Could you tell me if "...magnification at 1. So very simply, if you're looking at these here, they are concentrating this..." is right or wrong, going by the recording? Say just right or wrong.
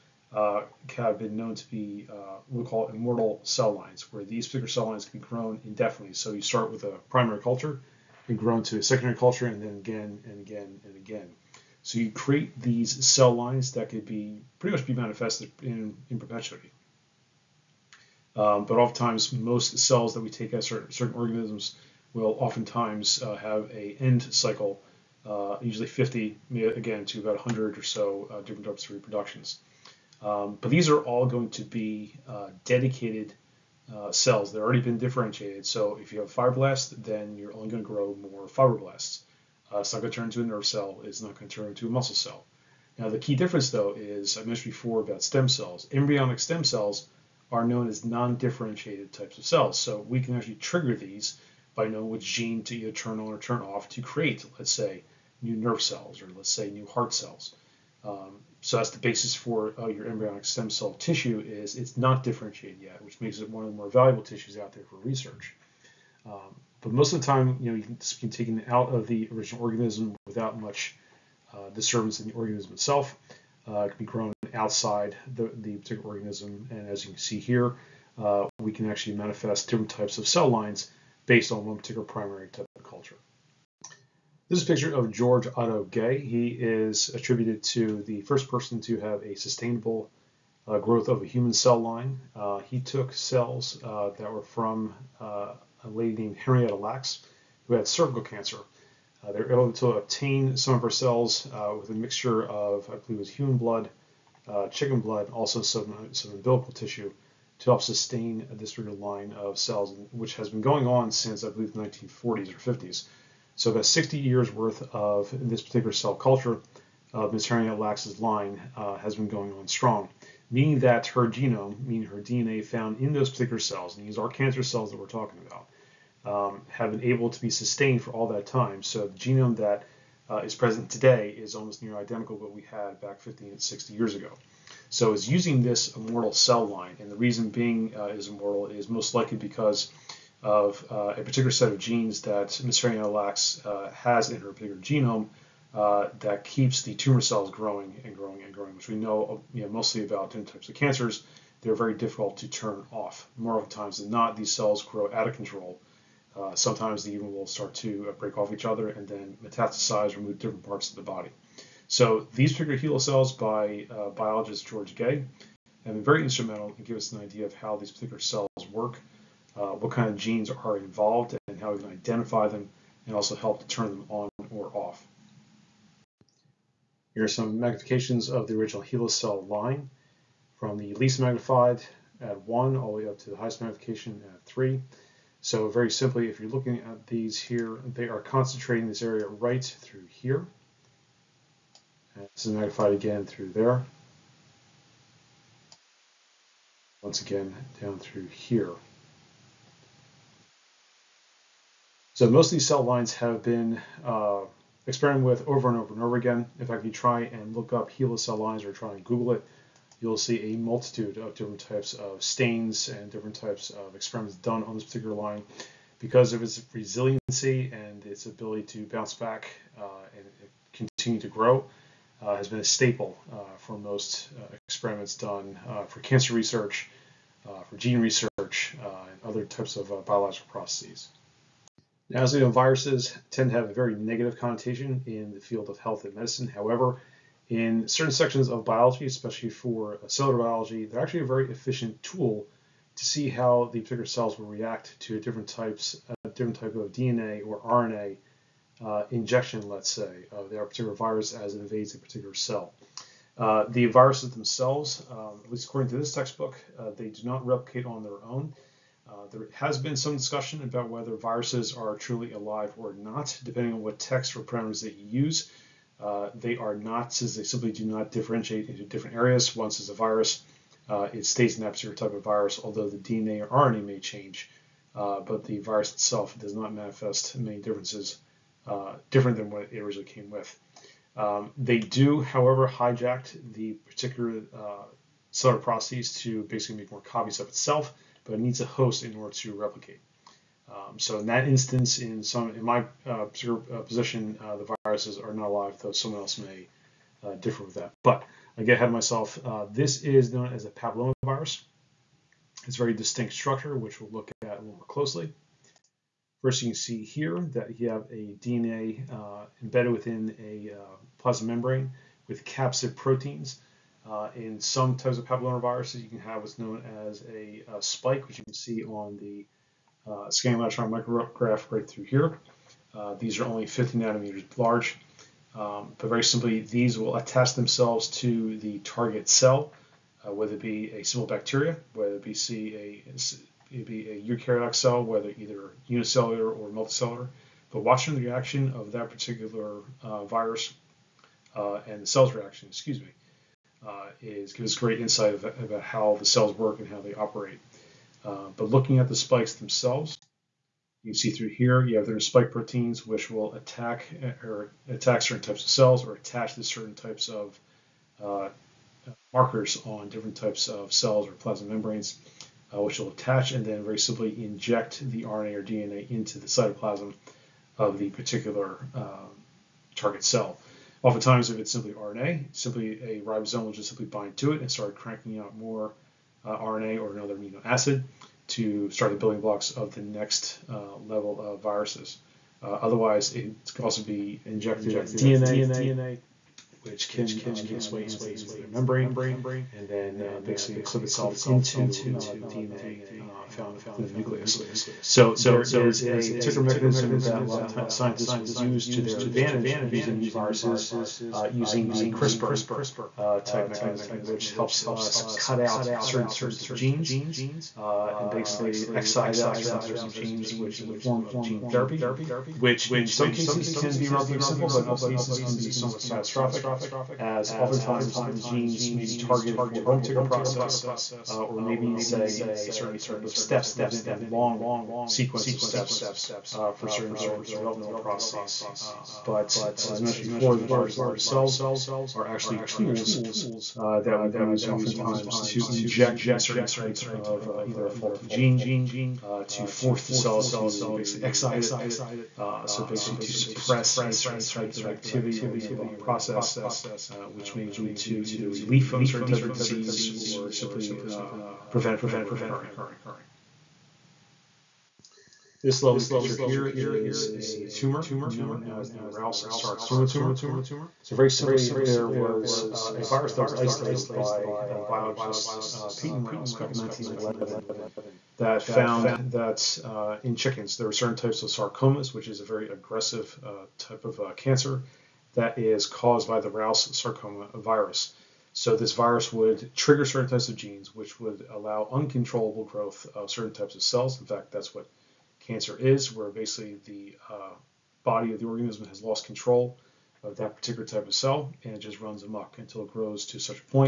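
wrong.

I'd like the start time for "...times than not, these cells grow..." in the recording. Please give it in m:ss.
2:33.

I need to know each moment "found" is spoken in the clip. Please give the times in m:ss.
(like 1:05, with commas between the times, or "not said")
2:02, 6:33, 7:48.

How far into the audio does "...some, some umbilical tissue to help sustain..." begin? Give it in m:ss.
1:45.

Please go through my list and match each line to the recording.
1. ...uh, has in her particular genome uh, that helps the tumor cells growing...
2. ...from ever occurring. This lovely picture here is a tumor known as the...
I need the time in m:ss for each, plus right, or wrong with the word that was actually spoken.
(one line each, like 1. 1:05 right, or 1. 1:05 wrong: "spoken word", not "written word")
1. 2:23 wrong: "keeps", not "helps"
2. 7:32 right.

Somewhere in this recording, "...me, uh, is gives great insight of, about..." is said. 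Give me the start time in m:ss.
5:43.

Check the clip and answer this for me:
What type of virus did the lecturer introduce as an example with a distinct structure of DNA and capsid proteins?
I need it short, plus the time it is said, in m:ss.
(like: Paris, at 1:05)
papillomavirus, at 5:00.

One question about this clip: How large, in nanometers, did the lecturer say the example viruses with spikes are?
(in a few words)
50 nanometers.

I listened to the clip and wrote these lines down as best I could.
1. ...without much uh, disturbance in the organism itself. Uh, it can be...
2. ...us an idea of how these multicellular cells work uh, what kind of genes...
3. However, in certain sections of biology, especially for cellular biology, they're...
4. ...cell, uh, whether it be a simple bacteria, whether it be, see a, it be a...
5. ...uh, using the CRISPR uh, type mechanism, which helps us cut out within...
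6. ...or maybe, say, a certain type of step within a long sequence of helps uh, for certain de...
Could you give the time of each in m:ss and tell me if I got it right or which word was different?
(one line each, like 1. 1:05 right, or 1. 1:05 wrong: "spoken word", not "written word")
1. 1:10 right
2. 2:46 wrong: "particular", not "multicellular"
3. 3:56 right
4. 5:29 right
5. 6:41 wrong: "certain", not "within"
6. 7:01 wrong: "steps", not "helps".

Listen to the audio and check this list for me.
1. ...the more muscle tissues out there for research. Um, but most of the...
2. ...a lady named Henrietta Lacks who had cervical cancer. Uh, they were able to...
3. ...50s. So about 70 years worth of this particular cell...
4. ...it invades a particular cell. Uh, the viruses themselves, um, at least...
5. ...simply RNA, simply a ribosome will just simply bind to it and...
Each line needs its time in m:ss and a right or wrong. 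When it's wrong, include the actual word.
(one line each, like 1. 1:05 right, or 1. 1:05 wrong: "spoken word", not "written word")
1. 1:03 wrong: "valuable", not "muscle"
2. 1:35 right
3. 1:52 wrong: "60", not "70"
4. 4:11 right
5. 6:11 right.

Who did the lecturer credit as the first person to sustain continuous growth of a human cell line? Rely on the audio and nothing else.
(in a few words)
George Otto Gey.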